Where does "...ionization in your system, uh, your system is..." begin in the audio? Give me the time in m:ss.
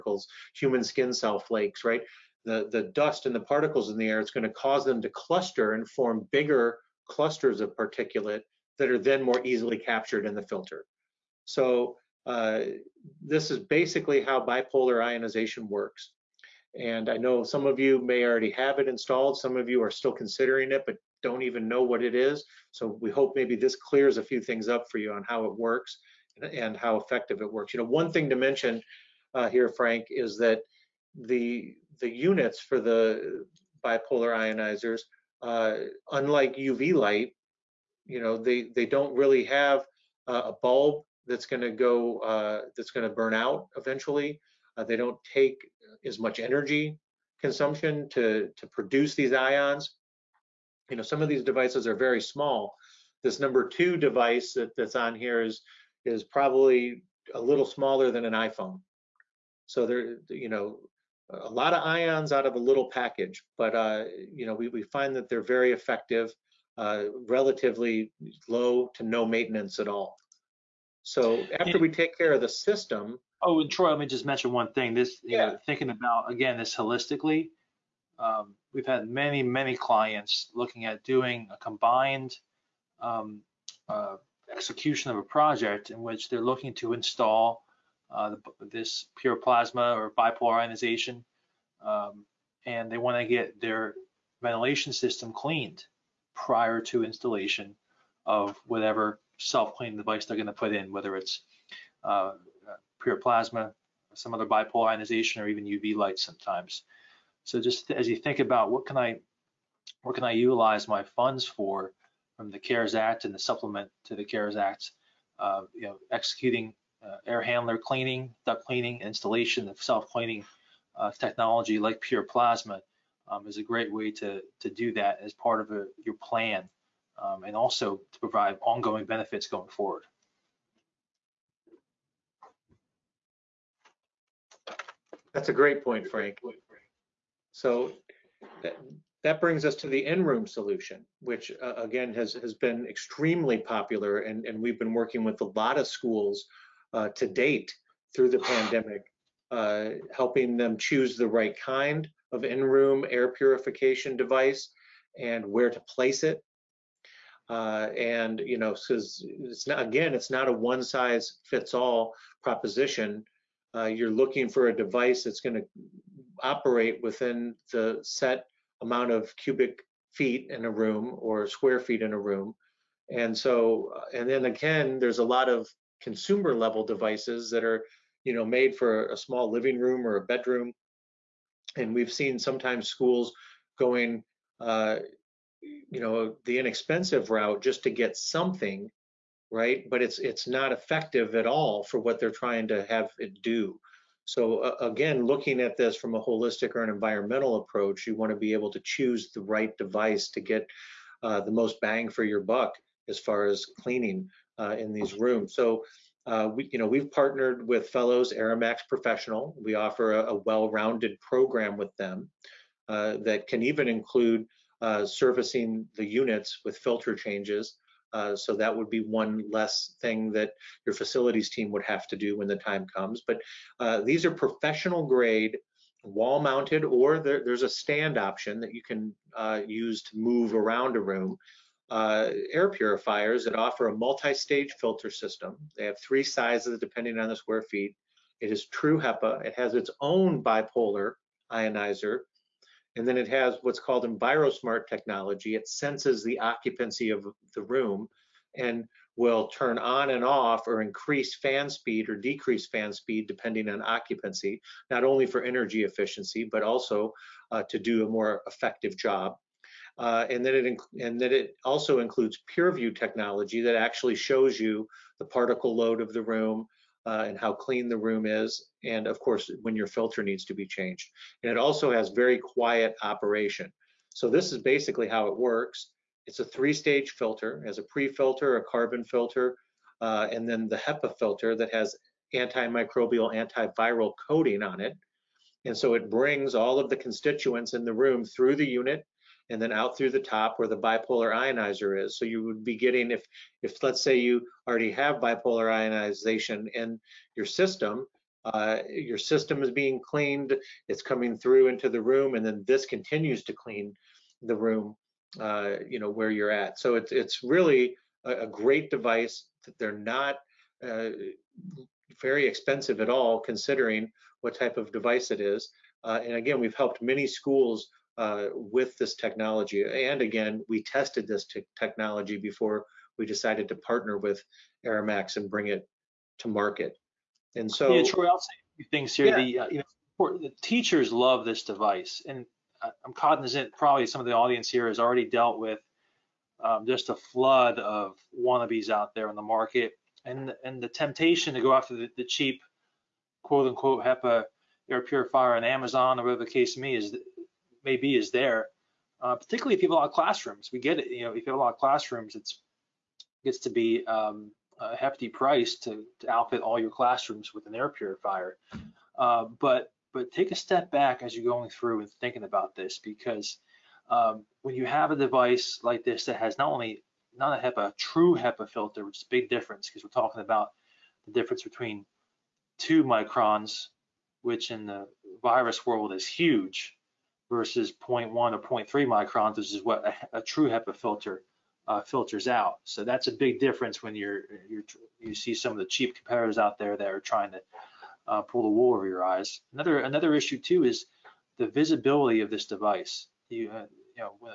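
4:55.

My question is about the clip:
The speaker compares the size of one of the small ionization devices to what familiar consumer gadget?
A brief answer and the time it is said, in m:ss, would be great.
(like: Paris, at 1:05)
iPhone, at 0:58.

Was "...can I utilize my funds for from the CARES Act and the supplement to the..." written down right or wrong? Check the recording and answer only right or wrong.
right.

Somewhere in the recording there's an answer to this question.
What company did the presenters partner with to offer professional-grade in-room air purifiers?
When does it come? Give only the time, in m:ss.
3:27.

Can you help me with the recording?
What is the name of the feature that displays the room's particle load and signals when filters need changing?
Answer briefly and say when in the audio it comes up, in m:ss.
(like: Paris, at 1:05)
PureView technology, at 4:22.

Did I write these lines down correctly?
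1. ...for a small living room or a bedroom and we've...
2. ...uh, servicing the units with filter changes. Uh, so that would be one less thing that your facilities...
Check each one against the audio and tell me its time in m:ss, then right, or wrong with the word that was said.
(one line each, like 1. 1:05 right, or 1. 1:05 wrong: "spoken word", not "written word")
1. 2:58 right
2. 3:34 right.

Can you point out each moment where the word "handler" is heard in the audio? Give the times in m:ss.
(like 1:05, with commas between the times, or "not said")
1:57.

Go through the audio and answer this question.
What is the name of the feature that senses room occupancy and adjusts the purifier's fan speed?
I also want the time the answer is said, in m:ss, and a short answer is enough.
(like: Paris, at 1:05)
EnviroSmart technology, at 4:04.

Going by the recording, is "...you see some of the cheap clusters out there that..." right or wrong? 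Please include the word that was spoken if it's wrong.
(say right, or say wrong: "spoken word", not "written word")
wrong: "competitors", not "clusters".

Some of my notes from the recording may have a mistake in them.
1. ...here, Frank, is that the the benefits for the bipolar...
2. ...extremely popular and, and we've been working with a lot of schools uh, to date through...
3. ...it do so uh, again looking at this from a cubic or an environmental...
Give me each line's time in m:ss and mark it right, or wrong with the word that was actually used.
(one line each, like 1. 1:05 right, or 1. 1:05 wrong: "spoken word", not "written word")
1. 0:29 wrong: "units", not "benefits"
2. 2:22 right
3. 3:13 wrong: "holistic", not "cubic".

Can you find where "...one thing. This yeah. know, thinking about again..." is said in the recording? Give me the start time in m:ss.
1:14.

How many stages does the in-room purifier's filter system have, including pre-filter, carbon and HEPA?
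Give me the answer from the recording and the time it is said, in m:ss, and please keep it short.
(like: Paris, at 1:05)
3, at 4:36.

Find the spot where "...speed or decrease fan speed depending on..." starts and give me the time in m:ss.
4:11.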